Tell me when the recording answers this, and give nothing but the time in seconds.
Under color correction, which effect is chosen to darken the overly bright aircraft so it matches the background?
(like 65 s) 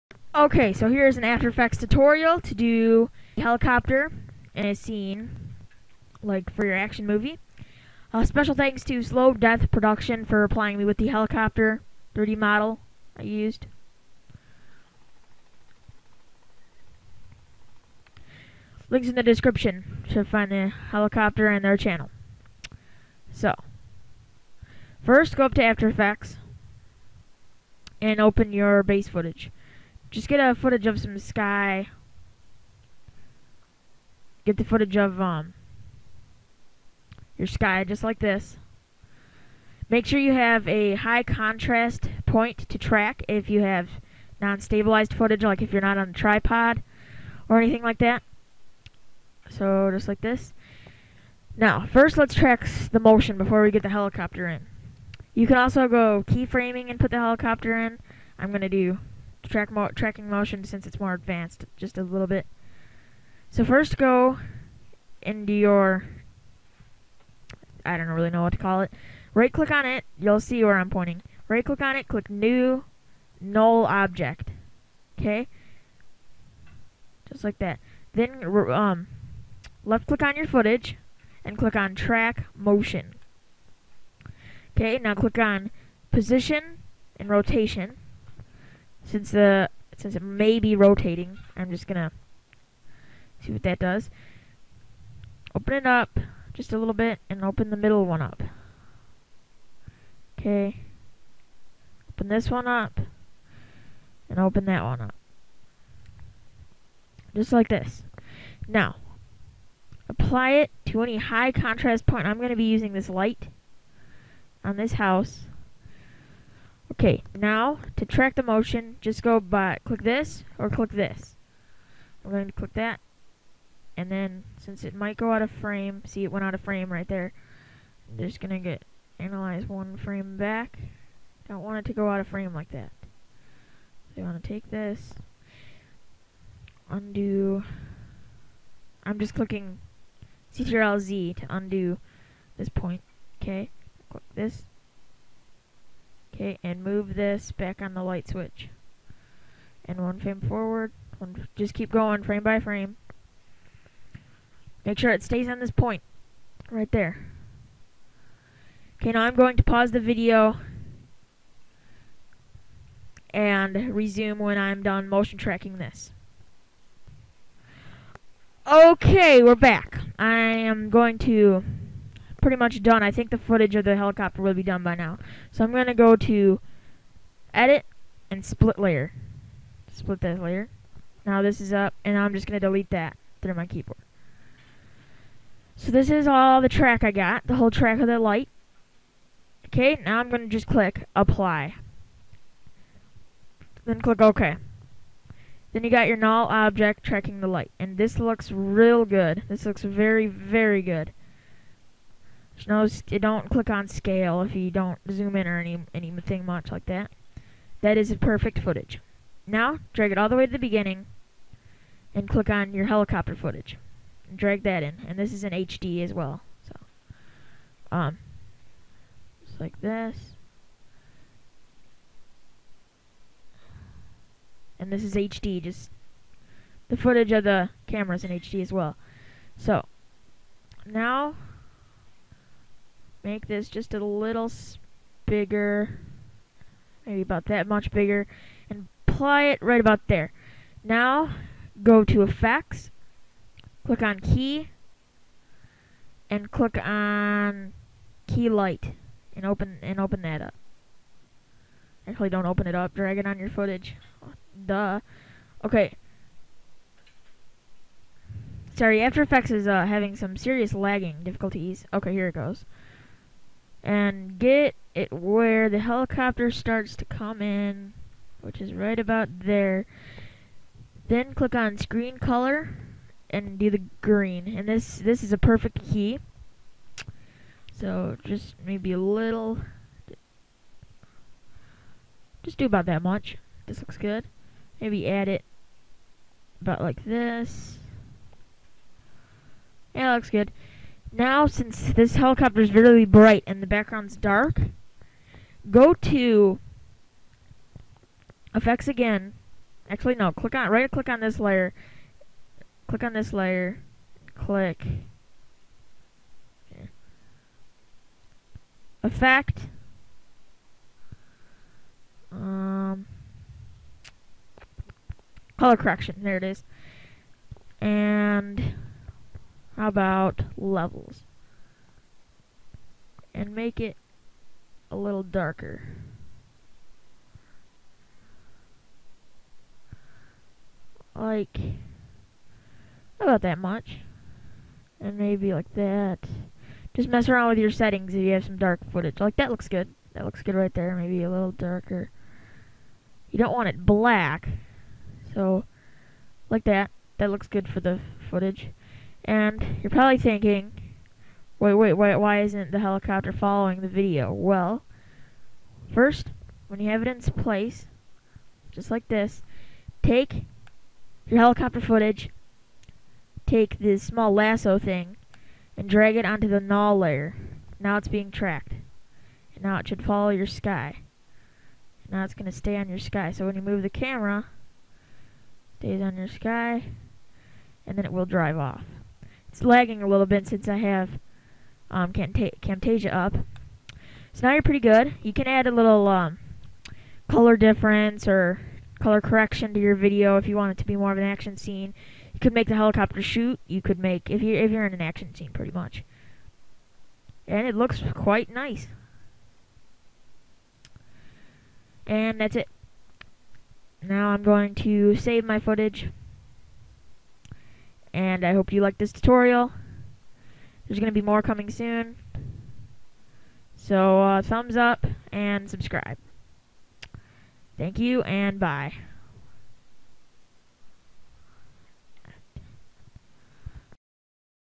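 320 s.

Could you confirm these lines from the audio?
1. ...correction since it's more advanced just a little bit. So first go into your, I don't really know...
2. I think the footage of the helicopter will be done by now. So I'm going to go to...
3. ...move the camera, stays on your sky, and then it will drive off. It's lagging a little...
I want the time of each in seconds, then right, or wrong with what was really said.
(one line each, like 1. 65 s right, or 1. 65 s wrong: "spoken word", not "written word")
1. 60 s wrong: "motion", not "correction"
2. 173 s right
3. 373 s right.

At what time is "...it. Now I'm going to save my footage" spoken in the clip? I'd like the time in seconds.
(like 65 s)
402 s.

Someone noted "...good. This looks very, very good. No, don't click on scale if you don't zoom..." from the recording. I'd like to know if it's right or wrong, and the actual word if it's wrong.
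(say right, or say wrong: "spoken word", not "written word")
right.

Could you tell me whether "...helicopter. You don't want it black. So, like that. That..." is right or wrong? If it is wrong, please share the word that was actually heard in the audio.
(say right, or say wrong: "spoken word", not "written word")
wrong: "darker", not "helicopter".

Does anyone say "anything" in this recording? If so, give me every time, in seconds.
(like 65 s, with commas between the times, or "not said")
47 s, 205 s.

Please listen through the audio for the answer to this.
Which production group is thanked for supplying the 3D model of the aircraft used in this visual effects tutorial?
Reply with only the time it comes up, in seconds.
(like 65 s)
9 s.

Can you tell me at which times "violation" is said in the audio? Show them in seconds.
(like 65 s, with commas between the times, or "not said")
not said.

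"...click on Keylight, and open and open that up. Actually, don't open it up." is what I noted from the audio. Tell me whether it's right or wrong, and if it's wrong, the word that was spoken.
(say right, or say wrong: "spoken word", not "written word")
right.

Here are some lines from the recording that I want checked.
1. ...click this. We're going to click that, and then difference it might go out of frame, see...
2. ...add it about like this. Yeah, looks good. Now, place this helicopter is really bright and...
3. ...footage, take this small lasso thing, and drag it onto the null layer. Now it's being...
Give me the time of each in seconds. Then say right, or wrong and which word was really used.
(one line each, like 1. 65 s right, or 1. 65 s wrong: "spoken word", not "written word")
1. 120 s wrong: "since", not "difference"
2. 285 s wrong: "since", not "place"
3. 361 s right.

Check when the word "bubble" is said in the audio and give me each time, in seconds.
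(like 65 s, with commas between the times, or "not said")
not said.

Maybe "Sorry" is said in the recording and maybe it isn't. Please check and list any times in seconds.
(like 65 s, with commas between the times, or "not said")
258 s.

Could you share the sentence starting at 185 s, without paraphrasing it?
So this is all the track I got, the whole track of the light.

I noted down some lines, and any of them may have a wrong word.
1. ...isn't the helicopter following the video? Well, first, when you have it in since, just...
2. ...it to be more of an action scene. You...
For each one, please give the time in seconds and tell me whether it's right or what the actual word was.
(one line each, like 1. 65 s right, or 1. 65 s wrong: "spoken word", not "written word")
1. 352 s wrong: "place", not "since"
2. 390 s right.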